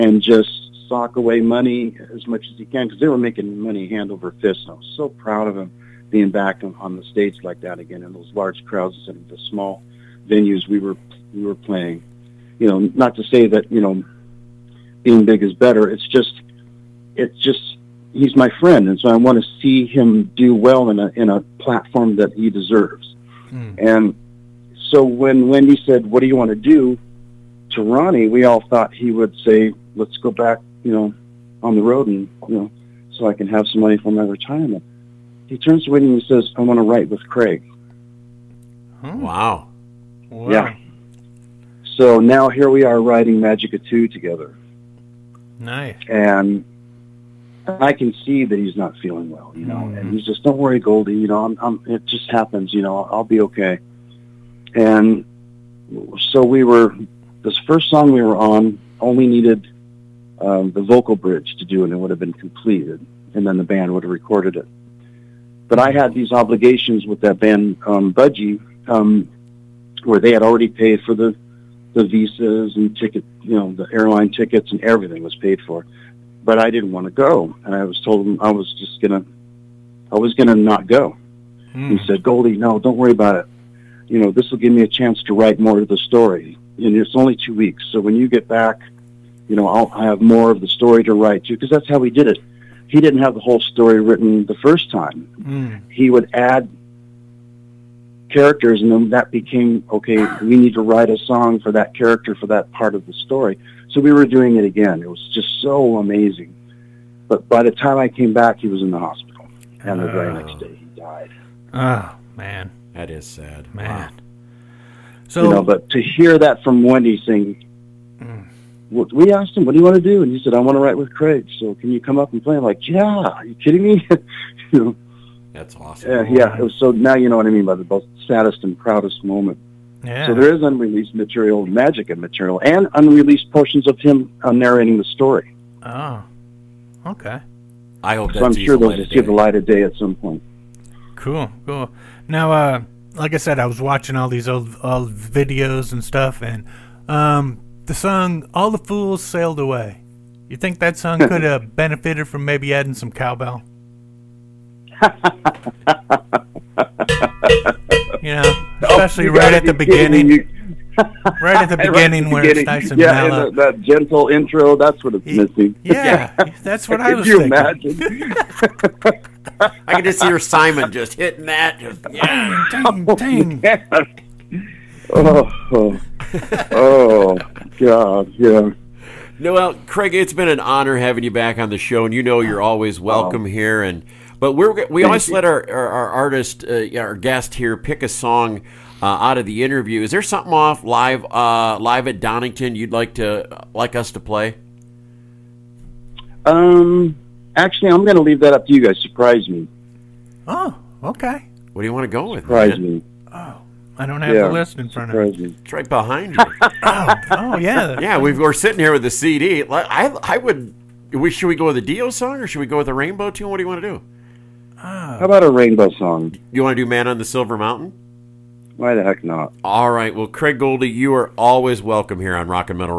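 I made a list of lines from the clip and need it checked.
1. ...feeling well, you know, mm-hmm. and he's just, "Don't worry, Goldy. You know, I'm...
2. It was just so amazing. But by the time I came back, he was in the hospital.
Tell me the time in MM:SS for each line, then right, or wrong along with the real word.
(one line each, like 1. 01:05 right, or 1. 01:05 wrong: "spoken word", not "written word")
1. 00:48 right
2. 01:45 right.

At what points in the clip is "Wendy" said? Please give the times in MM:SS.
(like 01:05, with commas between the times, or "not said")
00:25, 00:35, 01:56.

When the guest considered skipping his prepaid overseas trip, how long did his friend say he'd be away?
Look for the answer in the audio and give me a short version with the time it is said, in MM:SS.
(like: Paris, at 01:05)
2 weeks, at 01:27.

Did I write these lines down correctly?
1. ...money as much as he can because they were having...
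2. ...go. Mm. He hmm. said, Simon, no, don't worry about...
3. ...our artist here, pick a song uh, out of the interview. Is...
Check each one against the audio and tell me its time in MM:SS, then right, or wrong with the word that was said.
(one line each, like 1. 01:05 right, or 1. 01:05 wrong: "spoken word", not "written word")
1. 00:01 wrong: "making", not "having"
2. 01:20 wrong: "Goldy", not "Simon"
3. 03:06 wrong: "guest", not "artist".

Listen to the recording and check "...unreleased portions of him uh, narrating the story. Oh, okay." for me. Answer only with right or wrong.
right.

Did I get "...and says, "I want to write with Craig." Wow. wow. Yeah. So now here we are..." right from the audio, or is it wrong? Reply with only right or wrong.
right.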